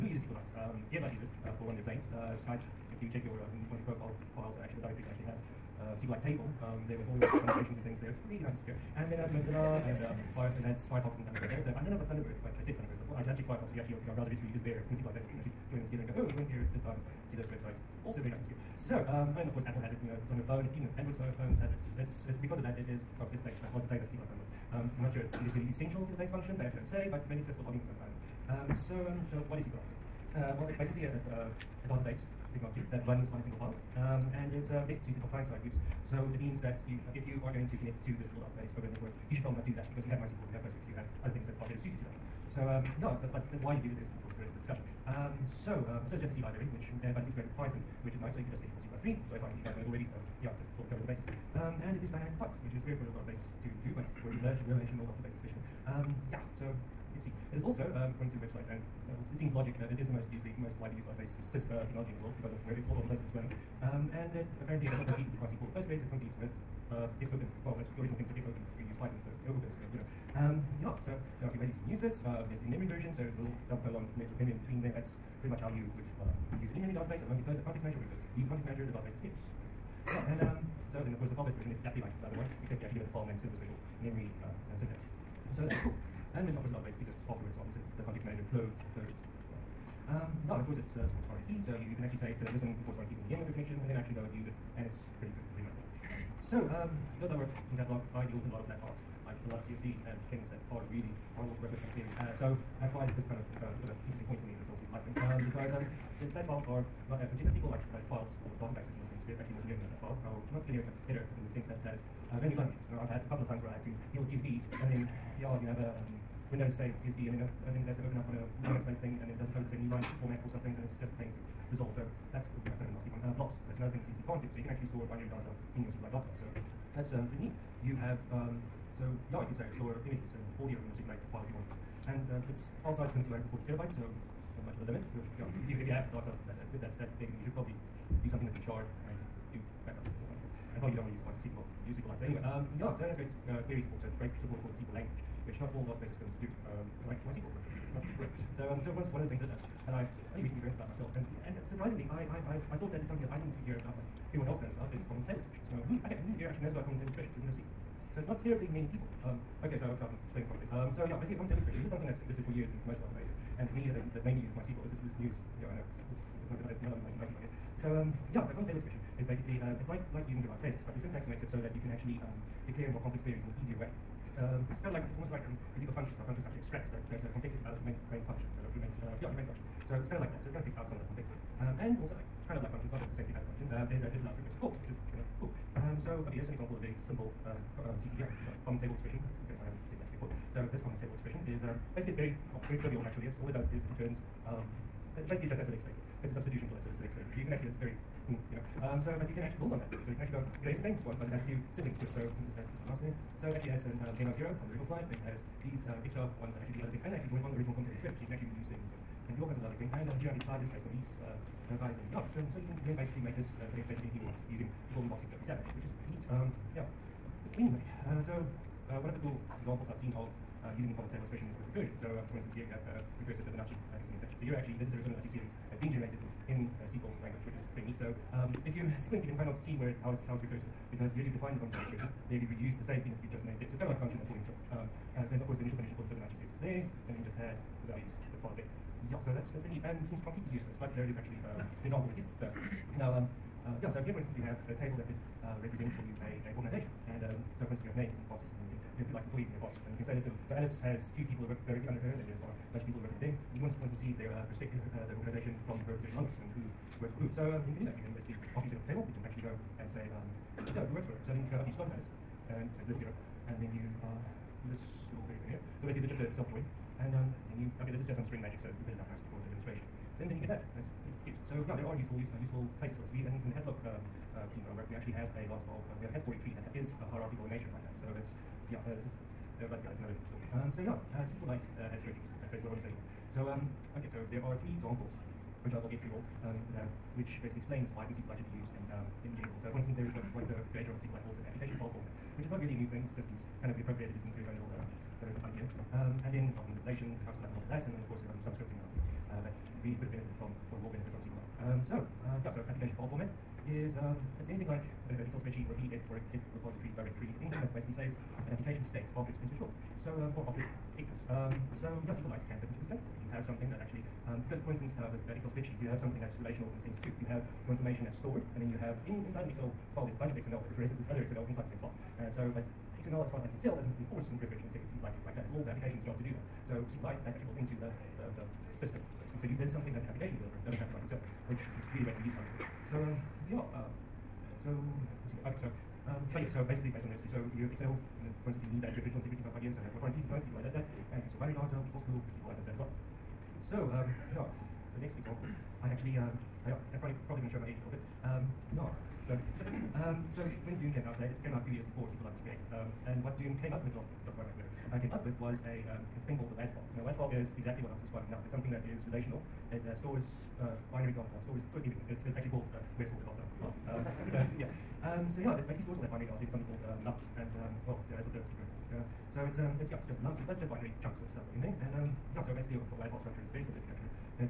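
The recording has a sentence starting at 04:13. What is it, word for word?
And you want to, for instance, see their uh, respective uh, the organization from her position onwards, and who works for who.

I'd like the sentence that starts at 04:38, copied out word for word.
So it's, yeah, this is, but yeah, that's another story.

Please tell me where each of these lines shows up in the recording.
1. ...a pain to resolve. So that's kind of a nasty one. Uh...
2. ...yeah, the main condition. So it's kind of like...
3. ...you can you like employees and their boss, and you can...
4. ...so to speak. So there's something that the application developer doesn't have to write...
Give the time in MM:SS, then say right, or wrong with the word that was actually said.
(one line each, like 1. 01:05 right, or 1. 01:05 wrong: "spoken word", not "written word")
1. 02:01 right
2. 02:59 wrong: "function", not "condition"
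3. 04:08 right
4. 05:28 right.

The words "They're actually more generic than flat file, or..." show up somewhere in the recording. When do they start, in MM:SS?
01:49.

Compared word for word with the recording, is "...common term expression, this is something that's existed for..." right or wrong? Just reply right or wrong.
right.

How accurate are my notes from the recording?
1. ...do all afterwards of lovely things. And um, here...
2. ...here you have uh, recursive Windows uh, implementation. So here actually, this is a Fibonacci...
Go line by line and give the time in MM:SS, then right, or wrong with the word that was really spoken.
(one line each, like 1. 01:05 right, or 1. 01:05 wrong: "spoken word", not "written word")
1. 03:29 wrong: "kinds", not "afterwards"
2. 03:42 wrong: "Fibonacci", not "Windows".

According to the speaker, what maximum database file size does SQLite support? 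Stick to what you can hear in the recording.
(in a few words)
240 terabytes.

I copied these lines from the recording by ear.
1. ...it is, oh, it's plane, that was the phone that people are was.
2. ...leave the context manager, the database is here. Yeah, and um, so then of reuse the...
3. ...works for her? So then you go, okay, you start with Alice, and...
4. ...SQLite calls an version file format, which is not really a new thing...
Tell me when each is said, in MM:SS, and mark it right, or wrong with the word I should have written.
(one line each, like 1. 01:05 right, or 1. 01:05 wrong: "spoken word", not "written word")
1. 00:22 wrong: "plane", not "phone"
2. 01:18 wrong: "course", not "reuse"
3. 04:20 right
4. 04:51 wrong: "application", not "version".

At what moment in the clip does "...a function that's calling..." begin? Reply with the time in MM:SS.
03:53.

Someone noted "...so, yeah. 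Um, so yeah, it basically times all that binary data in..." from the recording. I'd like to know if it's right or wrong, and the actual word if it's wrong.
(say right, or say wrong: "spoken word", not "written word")
wrong: "stores", not "times".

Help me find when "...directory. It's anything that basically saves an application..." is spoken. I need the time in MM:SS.
05:06.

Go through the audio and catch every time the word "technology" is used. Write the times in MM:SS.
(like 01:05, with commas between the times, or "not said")
00:32, 01:01.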